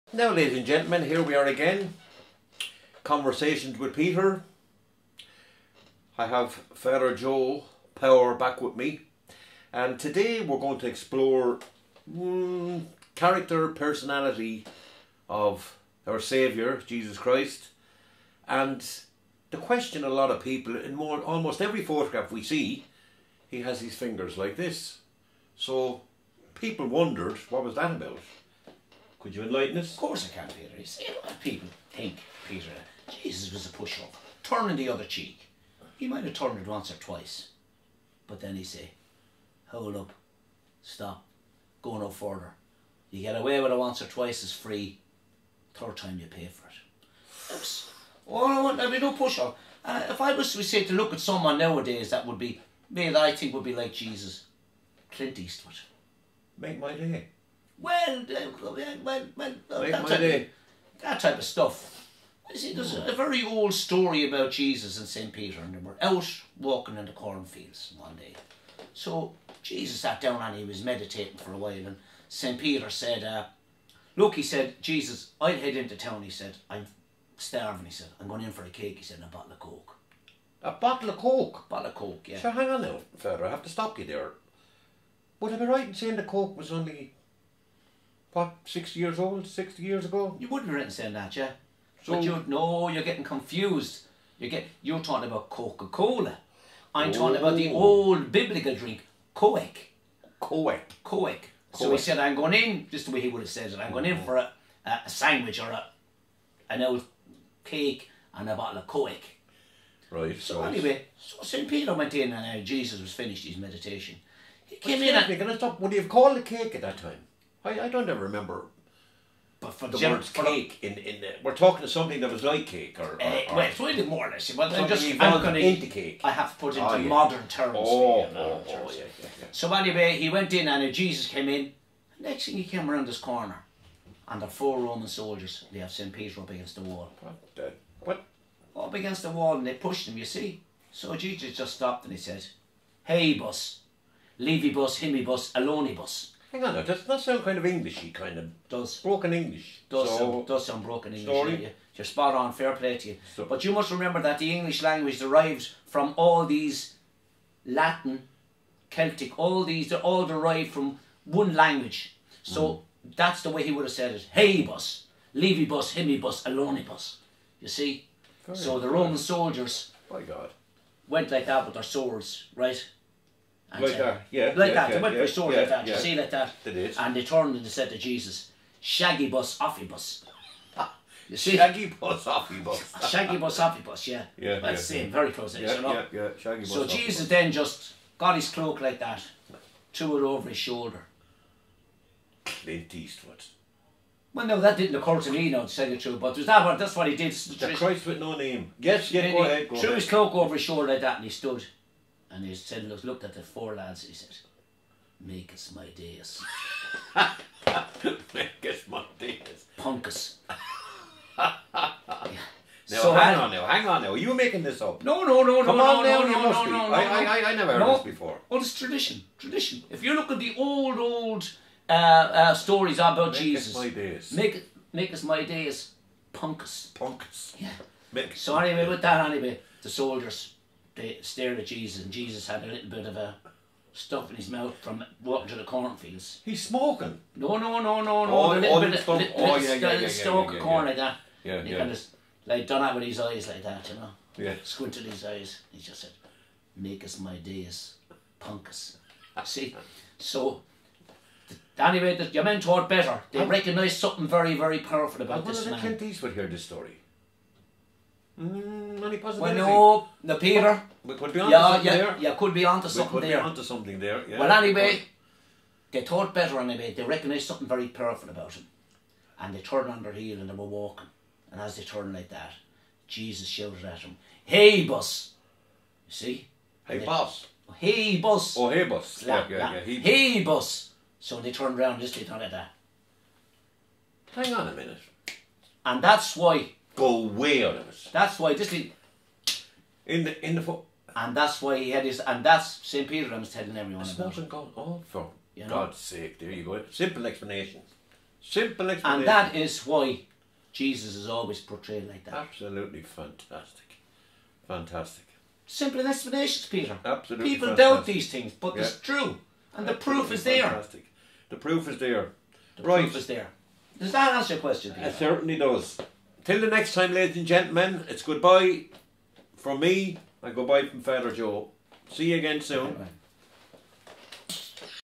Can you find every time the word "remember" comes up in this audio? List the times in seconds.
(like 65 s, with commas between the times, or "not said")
118 s, 153 s.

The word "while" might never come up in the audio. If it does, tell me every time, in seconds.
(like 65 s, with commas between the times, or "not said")
71 s.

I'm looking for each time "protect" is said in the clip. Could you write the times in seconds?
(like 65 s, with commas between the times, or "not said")
not said.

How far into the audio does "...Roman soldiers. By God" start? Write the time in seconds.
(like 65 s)
168 s.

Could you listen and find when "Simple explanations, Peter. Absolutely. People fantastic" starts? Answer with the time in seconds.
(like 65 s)
305 s.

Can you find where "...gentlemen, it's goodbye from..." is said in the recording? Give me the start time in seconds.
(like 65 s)
317 s.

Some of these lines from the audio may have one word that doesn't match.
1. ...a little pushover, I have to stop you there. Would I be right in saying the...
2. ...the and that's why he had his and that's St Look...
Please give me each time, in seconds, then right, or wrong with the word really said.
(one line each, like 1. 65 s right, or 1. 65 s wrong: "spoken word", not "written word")
1. 82 s wrong: "further", not "pushover"
2. 290 s wrong: "Peter", not "Look".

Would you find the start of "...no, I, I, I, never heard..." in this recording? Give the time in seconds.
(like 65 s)
216 s.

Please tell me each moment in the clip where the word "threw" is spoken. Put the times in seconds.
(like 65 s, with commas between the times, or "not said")
189 s, 199 s.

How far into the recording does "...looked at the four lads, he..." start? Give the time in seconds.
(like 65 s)
203 s.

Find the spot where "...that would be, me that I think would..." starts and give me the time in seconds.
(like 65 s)
52 s.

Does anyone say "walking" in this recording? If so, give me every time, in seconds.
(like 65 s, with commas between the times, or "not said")
66 s, 235 s, 270 s.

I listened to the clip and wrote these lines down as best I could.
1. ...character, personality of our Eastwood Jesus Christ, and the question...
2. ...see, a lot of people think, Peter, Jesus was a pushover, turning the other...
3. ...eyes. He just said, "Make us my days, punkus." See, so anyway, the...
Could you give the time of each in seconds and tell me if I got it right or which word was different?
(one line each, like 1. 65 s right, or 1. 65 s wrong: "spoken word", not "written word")
1. 13 s wrong: "Saviour", not "Eastwood"
2. 30 s right
3. 245 s right.